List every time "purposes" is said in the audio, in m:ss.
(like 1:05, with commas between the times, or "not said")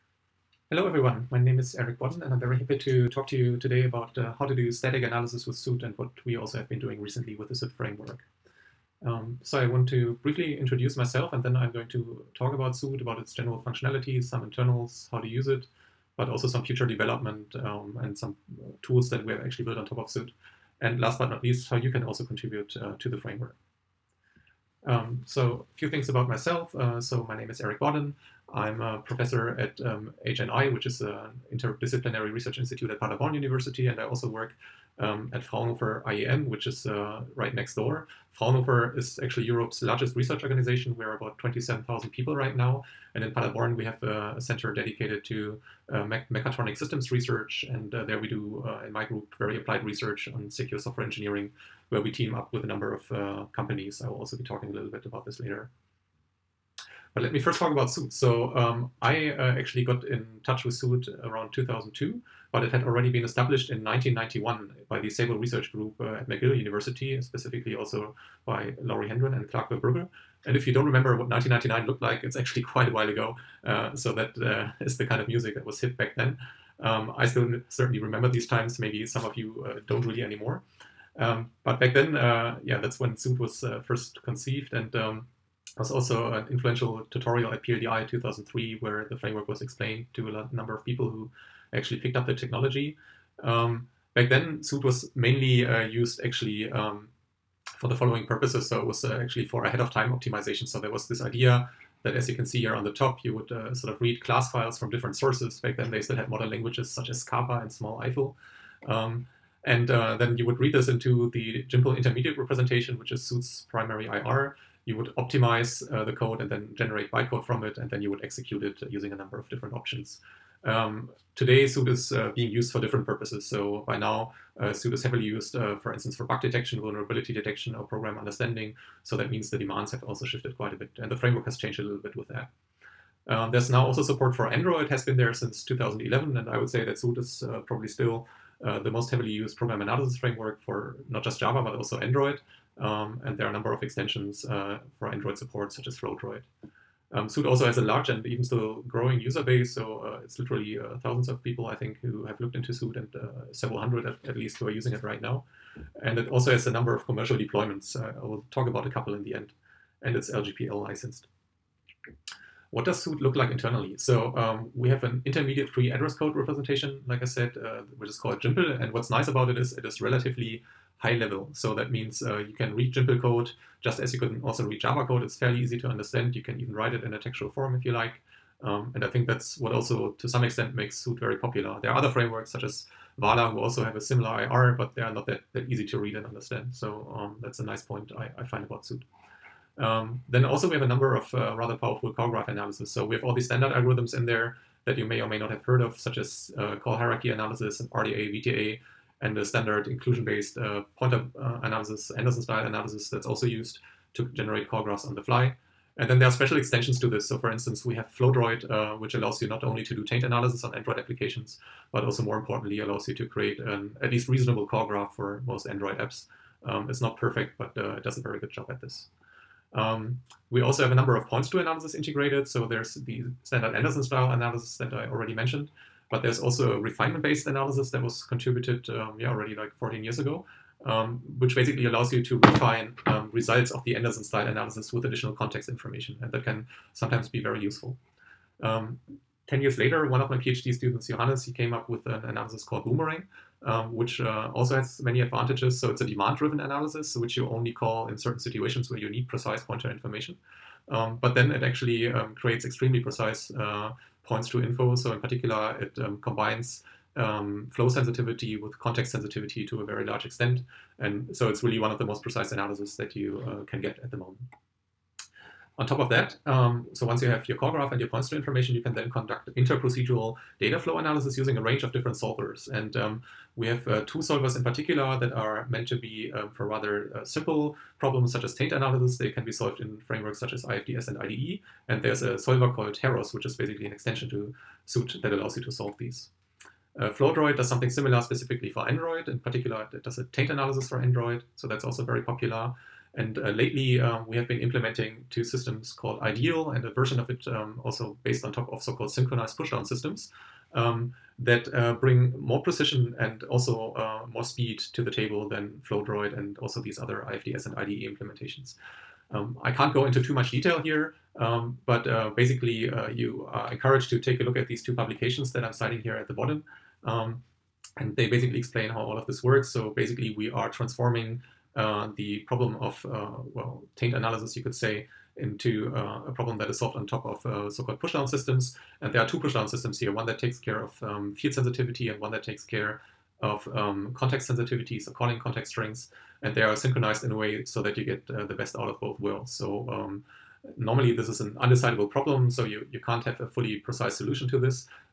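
1:38, 2:03.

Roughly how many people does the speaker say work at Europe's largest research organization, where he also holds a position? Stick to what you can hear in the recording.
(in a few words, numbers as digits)
27,000.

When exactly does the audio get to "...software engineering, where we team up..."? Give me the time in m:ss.
0:50.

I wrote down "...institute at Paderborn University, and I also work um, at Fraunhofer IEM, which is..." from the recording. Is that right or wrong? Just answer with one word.
right.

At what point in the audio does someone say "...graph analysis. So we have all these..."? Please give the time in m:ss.
3:12.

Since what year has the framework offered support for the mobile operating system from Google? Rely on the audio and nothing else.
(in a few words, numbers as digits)
2011.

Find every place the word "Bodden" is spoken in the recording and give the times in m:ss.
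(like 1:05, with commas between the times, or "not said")
0:01, 0:27.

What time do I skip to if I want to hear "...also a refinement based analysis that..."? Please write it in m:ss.
3:46.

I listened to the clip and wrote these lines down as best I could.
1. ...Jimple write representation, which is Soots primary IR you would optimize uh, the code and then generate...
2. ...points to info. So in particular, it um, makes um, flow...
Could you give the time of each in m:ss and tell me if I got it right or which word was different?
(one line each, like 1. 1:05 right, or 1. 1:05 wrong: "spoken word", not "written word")
1. 1:51 wrong: "intermediate", not "write"
2. 4:14 wrong: "combines", not "makes".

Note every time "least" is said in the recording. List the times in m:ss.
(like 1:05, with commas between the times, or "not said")
0:21, 2:34, 3:34.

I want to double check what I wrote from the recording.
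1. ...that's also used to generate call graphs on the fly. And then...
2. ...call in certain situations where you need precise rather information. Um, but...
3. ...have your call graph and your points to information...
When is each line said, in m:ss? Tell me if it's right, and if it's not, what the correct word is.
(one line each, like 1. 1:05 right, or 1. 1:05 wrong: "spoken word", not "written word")
1. 3:23 right
2. 4:07 wrong: "pointer", not "rather"
3. 4:27 right.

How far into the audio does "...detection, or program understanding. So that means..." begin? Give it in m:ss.
2:07.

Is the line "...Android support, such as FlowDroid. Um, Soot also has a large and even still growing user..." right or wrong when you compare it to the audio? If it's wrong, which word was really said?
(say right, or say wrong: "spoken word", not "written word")
right.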